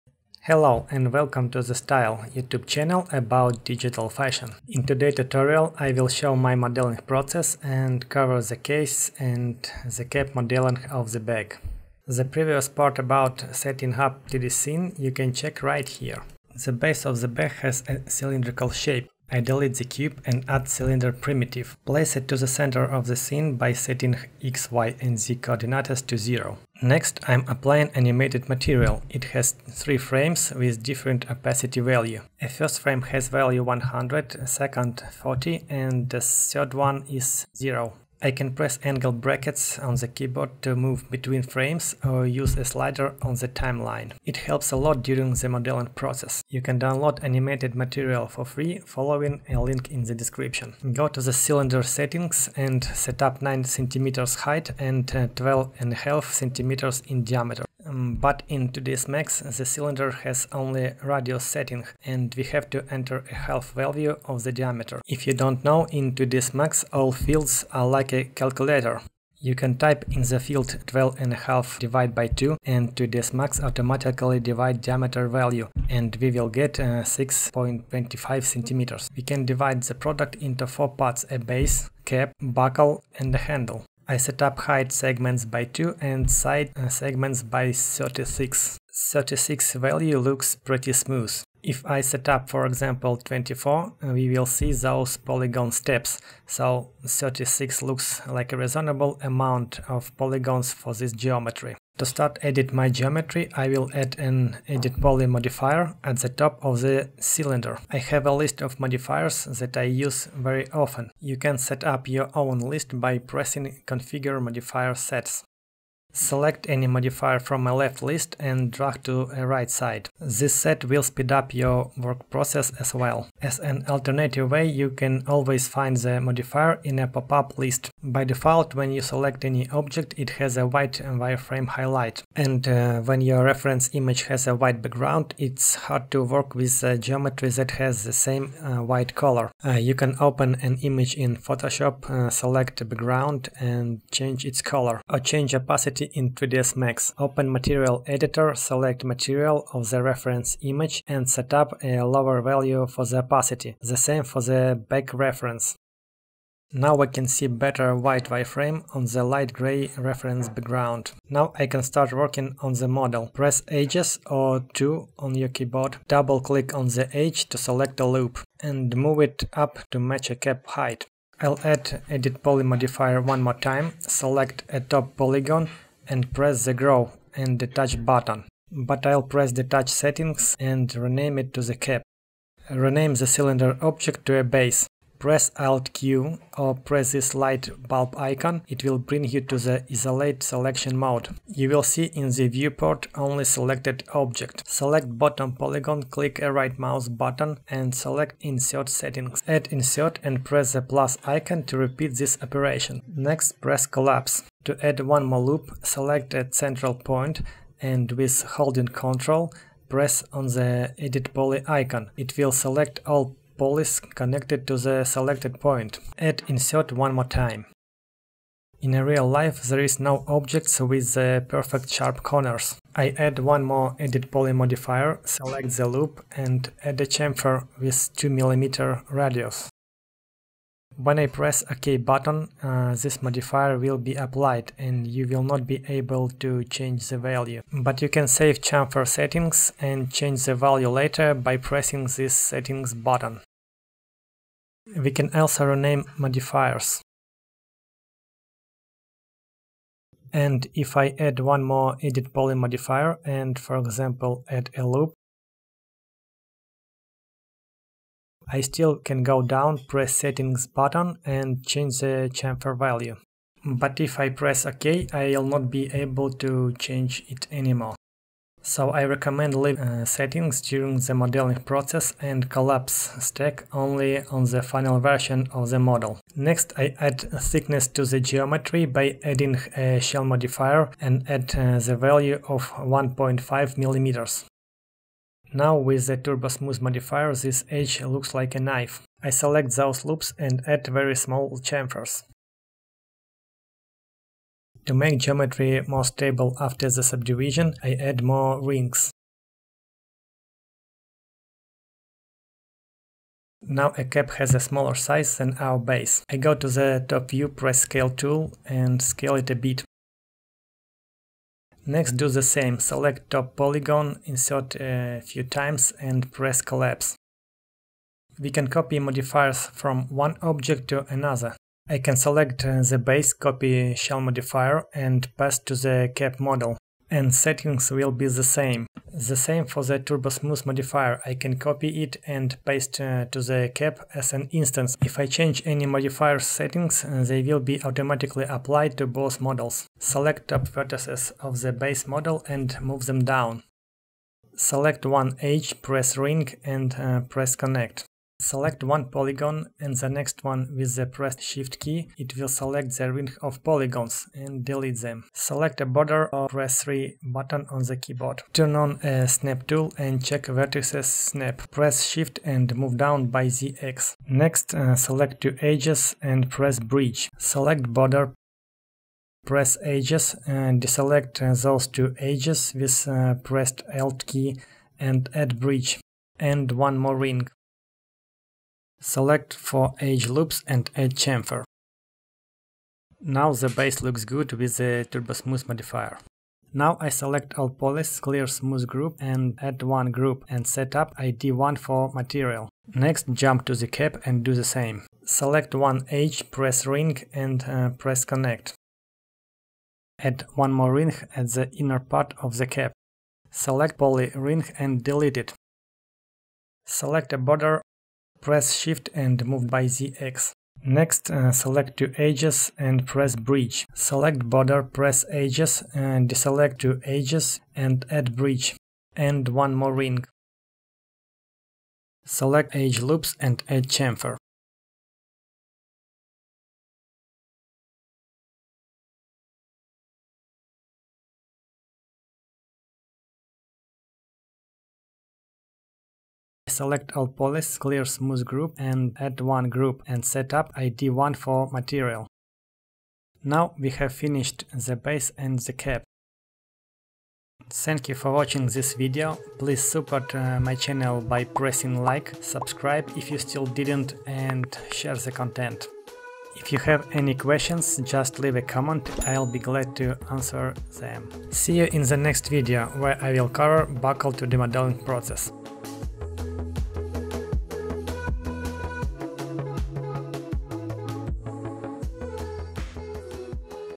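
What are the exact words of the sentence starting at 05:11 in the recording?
Next do the same, select top polygon, insert a few times and press collapse.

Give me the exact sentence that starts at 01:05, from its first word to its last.
If you don't know, in 3ds Max all fields are like a calculator.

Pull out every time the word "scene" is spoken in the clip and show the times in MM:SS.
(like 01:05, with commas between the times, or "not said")
00:14, 00:23.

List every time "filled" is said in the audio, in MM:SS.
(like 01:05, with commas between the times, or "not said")
not said.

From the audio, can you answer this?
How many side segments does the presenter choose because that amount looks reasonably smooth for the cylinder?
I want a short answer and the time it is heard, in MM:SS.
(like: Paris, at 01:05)
36, at 01:26.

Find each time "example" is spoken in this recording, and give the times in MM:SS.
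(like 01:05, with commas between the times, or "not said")
01:32, 04:13.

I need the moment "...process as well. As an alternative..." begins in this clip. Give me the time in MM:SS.
02:02.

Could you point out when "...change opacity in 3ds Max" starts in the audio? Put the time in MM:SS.
02:25.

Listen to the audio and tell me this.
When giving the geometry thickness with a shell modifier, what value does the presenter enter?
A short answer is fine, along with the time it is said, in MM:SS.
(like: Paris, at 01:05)
1.5 mm, at 04:42.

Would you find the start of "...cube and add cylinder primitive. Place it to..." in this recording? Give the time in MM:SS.
00:19.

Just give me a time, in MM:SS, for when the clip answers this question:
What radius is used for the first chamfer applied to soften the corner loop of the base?
03:48.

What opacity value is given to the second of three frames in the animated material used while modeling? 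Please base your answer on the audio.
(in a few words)
40.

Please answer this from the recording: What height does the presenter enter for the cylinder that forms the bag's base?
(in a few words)
9 cm.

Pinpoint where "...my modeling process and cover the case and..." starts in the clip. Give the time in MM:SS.
00:06.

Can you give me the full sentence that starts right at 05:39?
Select top vertices of the base model and move them down.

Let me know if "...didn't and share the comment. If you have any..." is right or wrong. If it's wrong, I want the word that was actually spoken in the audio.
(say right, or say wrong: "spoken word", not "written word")
wrong: "content", not "comment".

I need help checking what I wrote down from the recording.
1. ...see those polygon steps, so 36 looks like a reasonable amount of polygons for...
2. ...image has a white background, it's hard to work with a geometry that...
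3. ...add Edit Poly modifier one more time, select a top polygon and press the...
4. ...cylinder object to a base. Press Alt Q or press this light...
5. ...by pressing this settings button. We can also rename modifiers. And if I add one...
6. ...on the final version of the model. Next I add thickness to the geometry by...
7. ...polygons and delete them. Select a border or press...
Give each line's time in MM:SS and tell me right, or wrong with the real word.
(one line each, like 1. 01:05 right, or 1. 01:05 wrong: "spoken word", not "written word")
1. 01:34 right
2. 02:13 right
3. 02:51 right
4. 03:03 right
5. 04:01 right
6. 04:34 right
7. 05:53 right.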